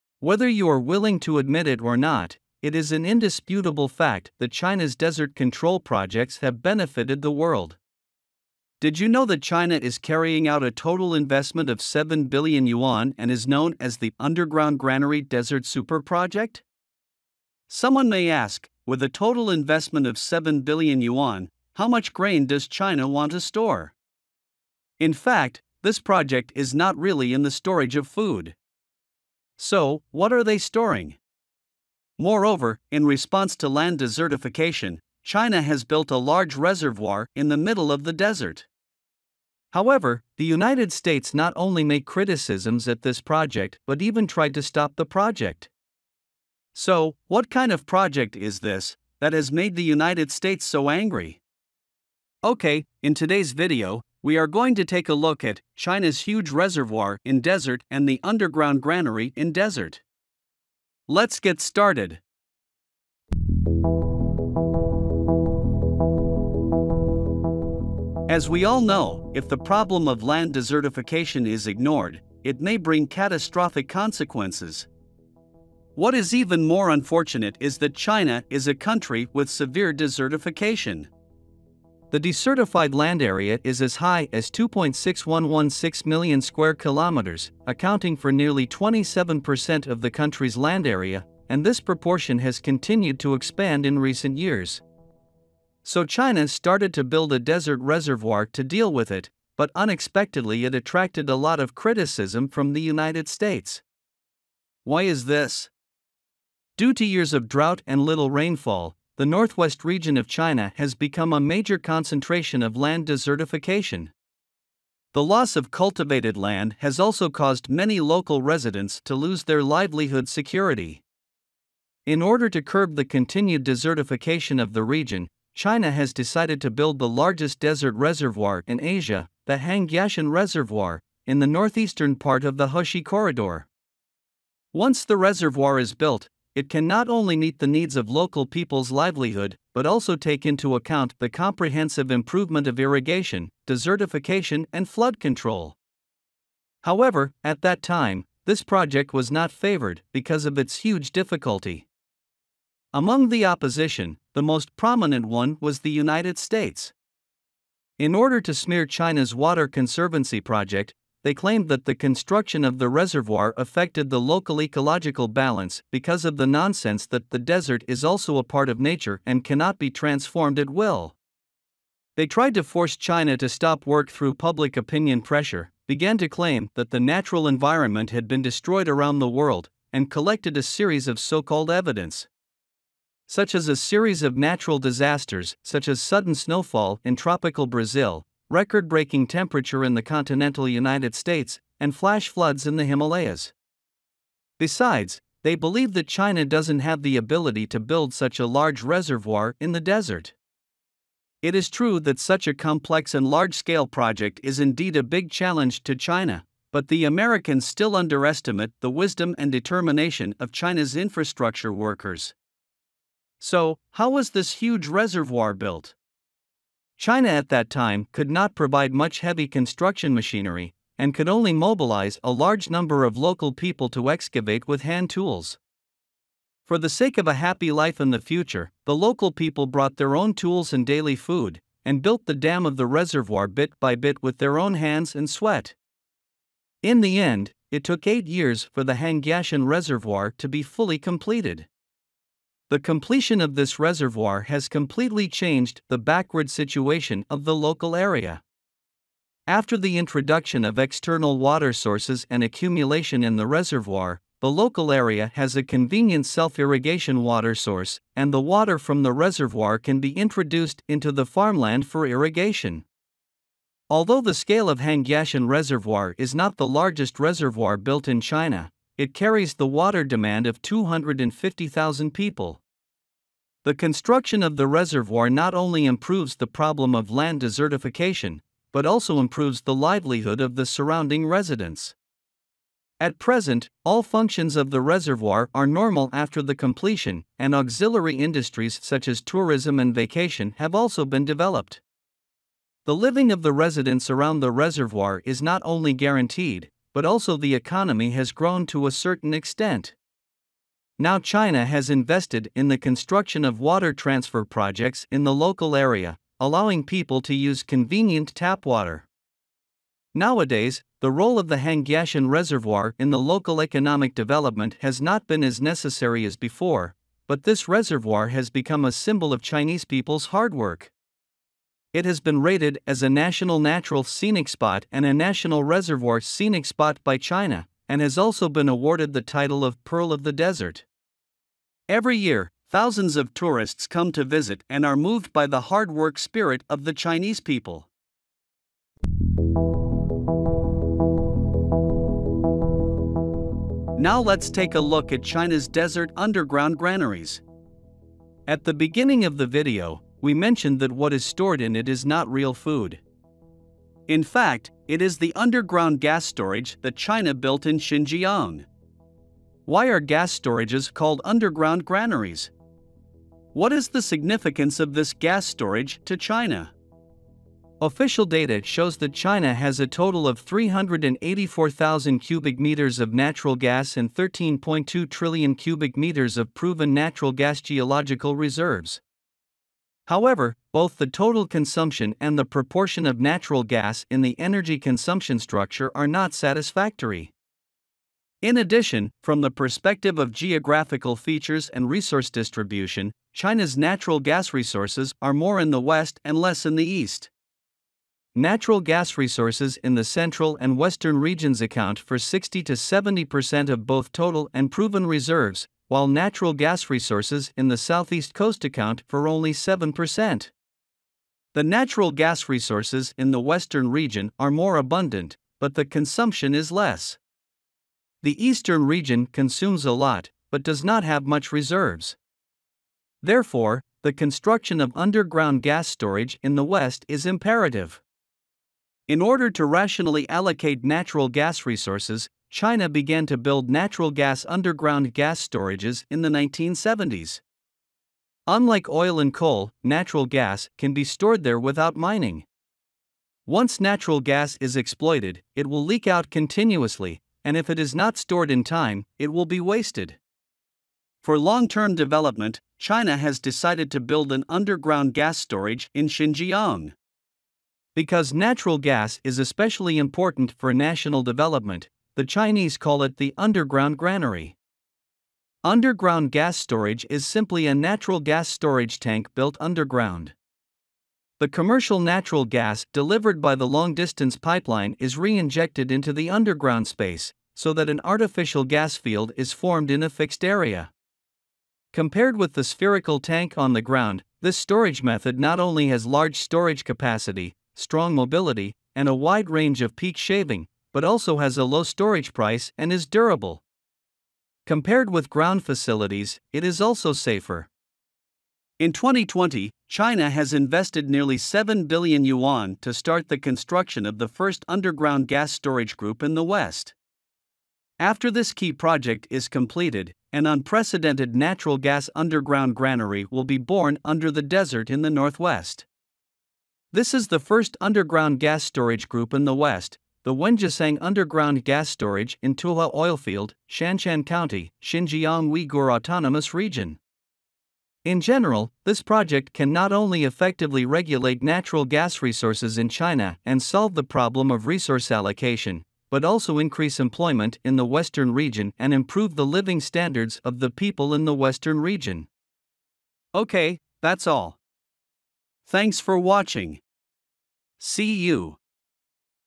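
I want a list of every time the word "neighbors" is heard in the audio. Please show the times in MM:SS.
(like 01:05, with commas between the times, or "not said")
not said.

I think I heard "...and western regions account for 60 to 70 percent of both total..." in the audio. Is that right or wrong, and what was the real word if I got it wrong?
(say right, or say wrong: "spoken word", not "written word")
right.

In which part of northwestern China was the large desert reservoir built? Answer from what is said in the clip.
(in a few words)
Hexi Corridor.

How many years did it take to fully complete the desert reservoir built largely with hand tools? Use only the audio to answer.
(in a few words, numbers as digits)
8.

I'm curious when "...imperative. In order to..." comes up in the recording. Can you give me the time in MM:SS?
07:07.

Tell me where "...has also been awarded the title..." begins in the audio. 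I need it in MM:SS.
05:28.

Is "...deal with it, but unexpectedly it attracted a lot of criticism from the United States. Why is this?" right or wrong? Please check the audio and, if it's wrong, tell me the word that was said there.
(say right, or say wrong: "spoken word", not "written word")
right.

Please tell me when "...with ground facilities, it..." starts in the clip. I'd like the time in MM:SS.
08:15.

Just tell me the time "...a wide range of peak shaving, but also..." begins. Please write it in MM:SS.
08:09.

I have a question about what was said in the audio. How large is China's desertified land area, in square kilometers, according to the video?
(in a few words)
2.6116 million.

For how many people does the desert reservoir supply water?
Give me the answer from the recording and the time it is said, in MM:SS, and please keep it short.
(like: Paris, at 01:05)
250,000, at 04:30.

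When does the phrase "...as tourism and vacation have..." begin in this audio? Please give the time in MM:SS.
04:49.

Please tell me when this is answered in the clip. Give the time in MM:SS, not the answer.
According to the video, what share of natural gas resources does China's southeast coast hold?
06:49.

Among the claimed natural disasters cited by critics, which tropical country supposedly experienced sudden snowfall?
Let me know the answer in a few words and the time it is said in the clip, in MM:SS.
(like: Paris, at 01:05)
Brazil, at 03:07.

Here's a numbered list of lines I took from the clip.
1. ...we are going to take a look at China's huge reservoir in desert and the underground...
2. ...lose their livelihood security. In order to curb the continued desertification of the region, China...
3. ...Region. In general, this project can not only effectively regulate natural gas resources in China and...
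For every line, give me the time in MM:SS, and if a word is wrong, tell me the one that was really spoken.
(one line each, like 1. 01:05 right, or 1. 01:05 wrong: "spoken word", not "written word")
1. 00:54 right
2. 01:59 right
3. 08:46 right.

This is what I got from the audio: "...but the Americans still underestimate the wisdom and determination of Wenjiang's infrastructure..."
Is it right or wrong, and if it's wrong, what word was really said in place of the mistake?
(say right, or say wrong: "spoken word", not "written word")
wrong: "China", not "Wenjiang".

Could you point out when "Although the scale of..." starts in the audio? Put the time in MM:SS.
04:23.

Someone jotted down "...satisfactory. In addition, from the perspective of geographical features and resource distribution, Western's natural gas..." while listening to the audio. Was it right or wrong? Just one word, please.
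wrong.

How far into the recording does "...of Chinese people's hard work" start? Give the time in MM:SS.
05:19.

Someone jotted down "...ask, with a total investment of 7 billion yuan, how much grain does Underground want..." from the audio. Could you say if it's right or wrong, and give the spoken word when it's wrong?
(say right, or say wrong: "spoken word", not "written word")
wrong: "China", not "Underground".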